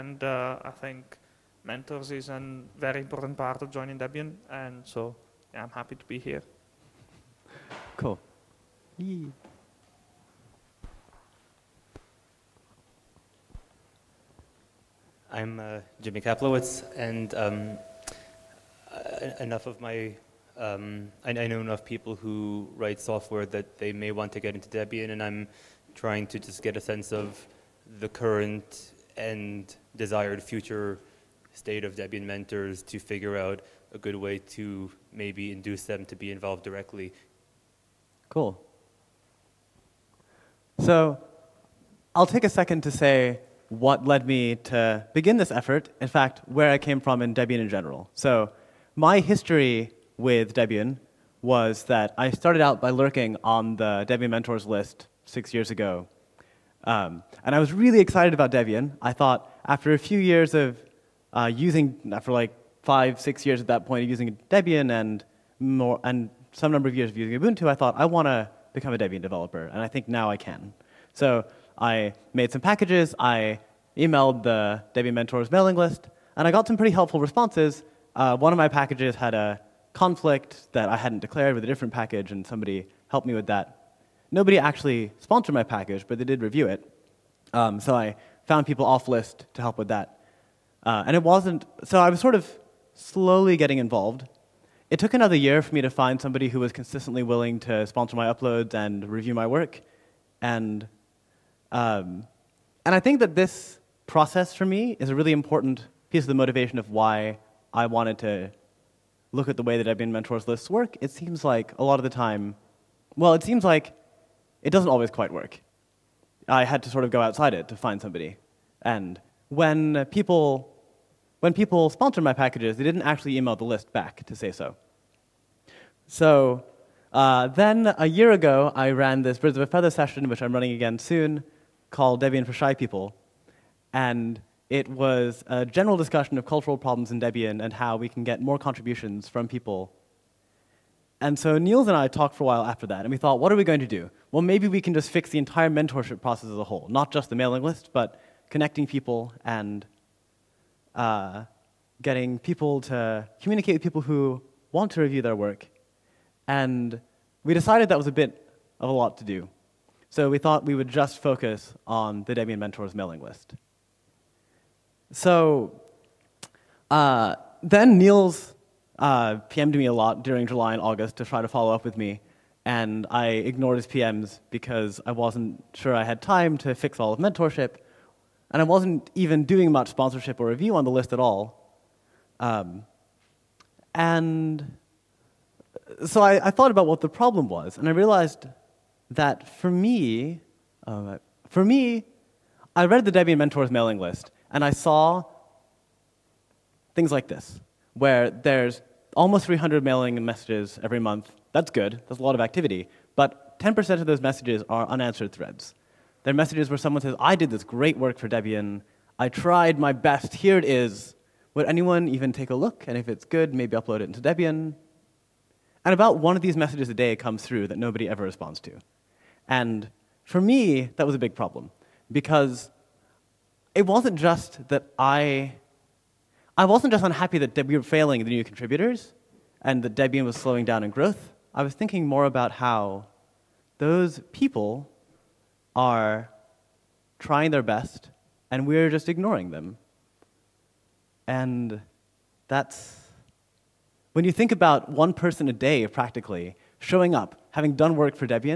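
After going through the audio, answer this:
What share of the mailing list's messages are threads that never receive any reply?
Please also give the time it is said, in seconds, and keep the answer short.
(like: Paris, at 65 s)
10%, at 203 s.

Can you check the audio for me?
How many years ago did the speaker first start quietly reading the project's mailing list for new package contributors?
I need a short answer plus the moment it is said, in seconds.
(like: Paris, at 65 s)
6, at 55 s.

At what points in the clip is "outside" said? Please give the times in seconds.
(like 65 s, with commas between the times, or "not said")
117 s.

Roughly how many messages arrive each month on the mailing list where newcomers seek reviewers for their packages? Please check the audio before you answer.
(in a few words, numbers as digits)
300.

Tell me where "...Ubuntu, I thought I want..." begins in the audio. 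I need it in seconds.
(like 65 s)
67 s.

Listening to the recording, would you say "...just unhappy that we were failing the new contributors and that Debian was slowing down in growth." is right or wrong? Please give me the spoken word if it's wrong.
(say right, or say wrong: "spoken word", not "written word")
right.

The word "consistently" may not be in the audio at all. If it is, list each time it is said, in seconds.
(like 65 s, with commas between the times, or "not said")
96 s.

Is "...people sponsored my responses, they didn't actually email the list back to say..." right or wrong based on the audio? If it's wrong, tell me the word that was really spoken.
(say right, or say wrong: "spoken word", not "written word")
wrong: "packages", not "responses".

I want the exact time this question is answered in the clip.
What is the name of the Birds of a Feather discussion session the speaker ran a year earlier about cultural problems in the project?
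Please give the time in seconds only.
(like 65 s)
132 s.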